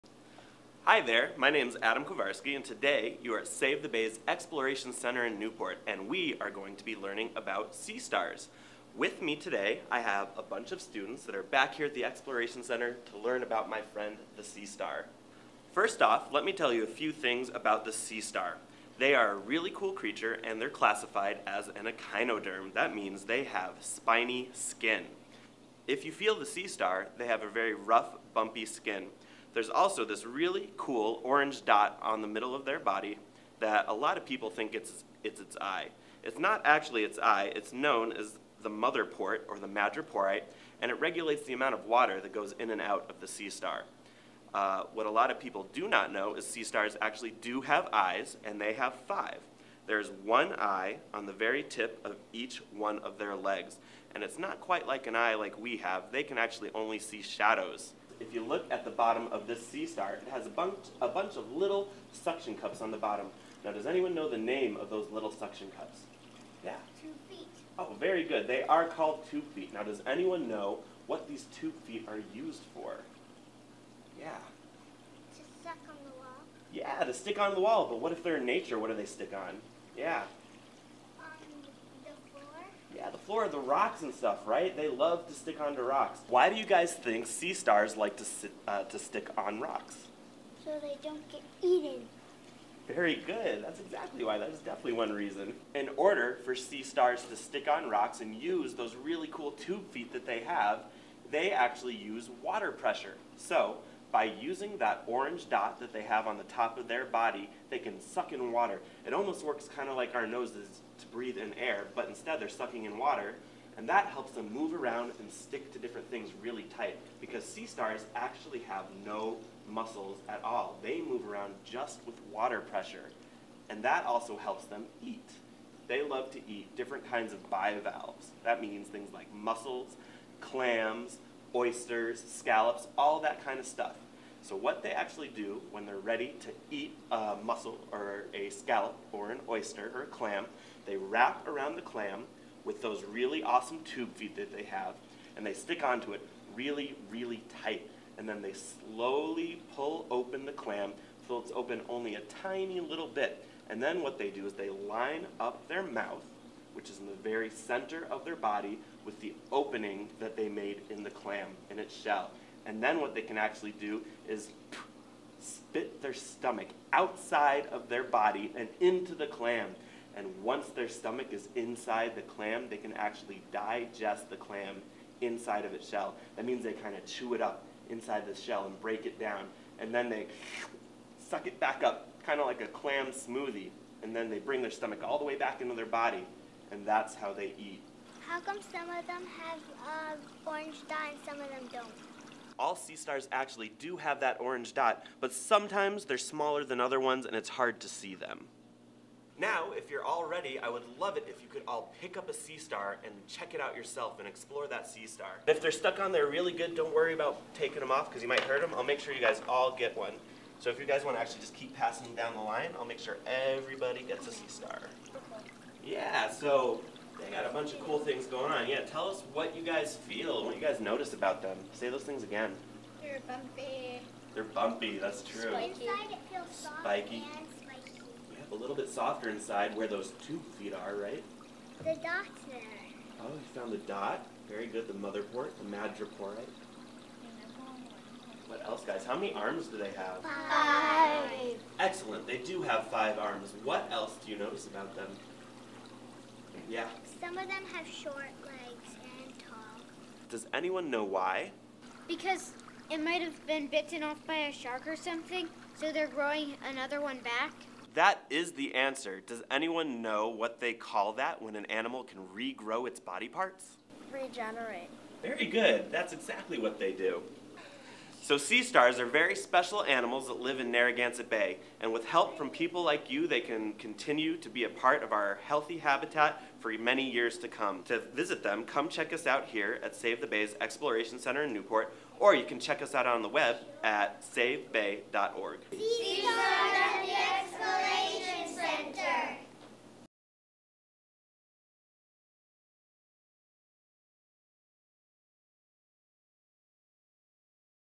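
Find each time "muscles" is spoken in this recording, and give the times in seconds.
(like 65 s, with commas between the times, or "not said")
119 s.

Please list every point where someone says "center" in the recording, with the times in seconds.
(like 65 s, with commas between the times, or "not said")
4 s, 12 s, 157 s, 281 s.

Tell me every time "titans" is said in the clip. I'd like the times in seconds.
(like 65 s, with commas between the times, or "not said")
not said.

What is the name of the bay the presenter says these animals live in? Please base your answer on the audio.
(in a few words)
Narragansett Bay.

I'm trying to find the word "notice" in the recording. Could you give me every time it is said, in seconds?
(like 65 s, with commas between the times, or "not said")
220 s, 244 s.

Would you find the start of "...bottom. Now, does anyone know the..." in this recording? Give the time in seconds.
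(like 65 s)
62 s.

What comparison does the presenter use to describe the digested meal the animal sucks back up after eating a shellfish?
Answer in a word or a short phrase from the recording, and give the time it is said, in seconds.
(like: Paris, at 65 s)
clam smoothie, at 182 s.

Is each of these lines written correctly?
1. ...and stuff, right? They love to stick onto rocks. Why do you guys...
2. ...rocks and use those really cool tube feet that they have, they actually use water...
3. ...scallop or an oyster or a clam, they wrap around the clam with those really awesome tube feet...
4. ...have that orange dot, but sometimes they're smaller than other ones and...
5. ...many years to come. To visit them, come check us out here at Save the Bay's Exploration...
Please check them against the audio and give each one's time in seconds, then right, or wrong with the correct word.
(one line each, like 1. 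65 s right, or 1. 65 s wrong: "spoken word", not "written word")
1. 84 s right
2. 97 s right
3. 138 s right
4. 193 s right
5. 276 s right.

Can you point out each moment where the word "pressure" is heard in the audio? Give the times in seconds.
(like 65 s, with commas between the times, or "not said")
102 s, 122 s.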